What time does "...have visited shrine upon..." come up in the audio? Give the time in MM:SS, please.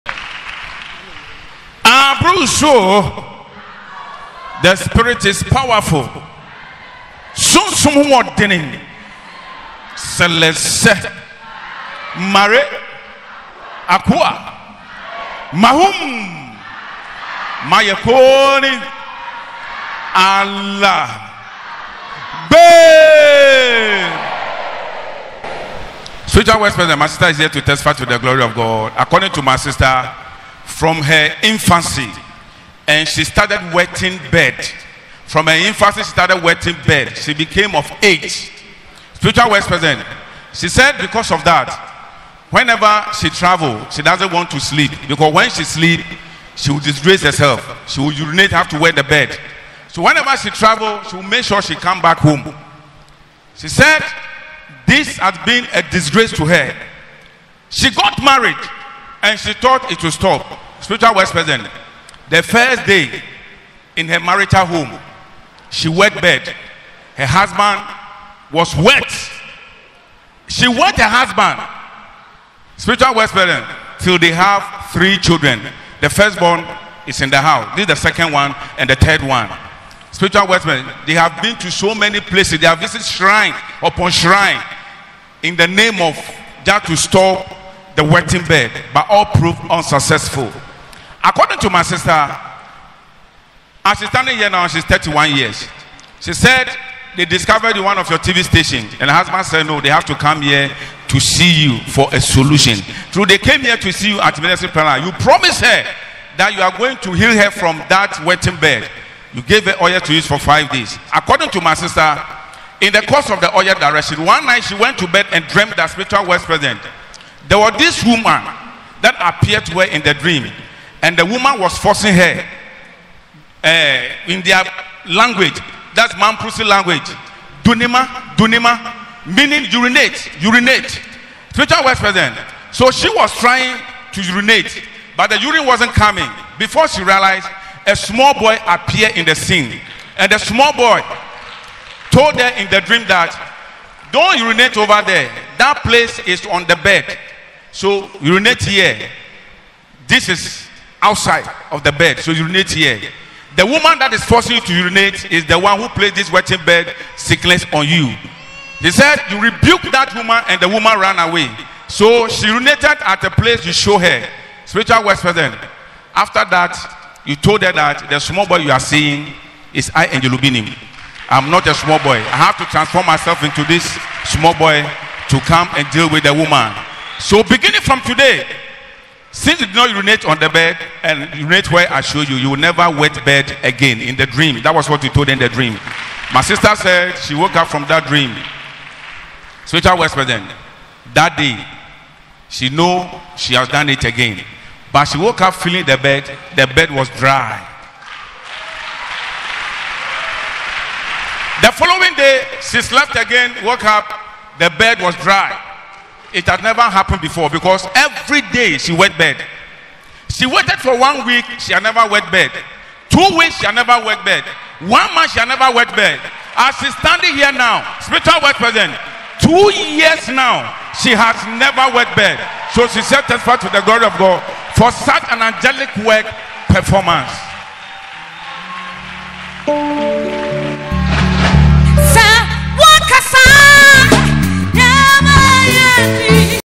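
01:22.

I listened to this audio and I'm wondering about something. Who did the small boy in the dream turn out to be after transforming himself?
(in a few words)
Angel Obinim.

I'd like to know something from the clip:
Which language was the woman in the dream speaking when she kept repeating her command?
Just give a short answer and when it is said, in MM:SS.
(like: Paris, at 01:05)
Mamprusi, at 02:06.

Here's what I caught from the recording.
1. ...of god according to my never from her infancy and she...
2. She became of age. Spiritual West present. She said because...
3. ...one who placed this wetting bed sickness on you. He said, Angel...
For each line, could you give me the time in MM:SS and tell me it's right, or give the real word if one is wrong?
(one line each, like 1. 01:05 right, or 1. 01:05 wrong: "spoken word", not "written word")
1. 00:28 wrong: "sister", not "never"
2. 00:37 right
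3. 02:35 wrong: "You", not "Angel".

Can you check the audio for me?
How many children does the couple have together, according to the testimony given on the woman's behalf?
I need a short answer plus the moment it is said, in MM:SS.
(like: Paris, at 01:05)
3, at 01:14.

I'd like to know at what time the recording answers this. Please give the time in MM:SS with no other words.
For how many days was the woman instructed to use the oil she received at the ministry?
01:50.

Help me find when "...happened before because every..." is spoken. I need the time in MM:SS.
03:26.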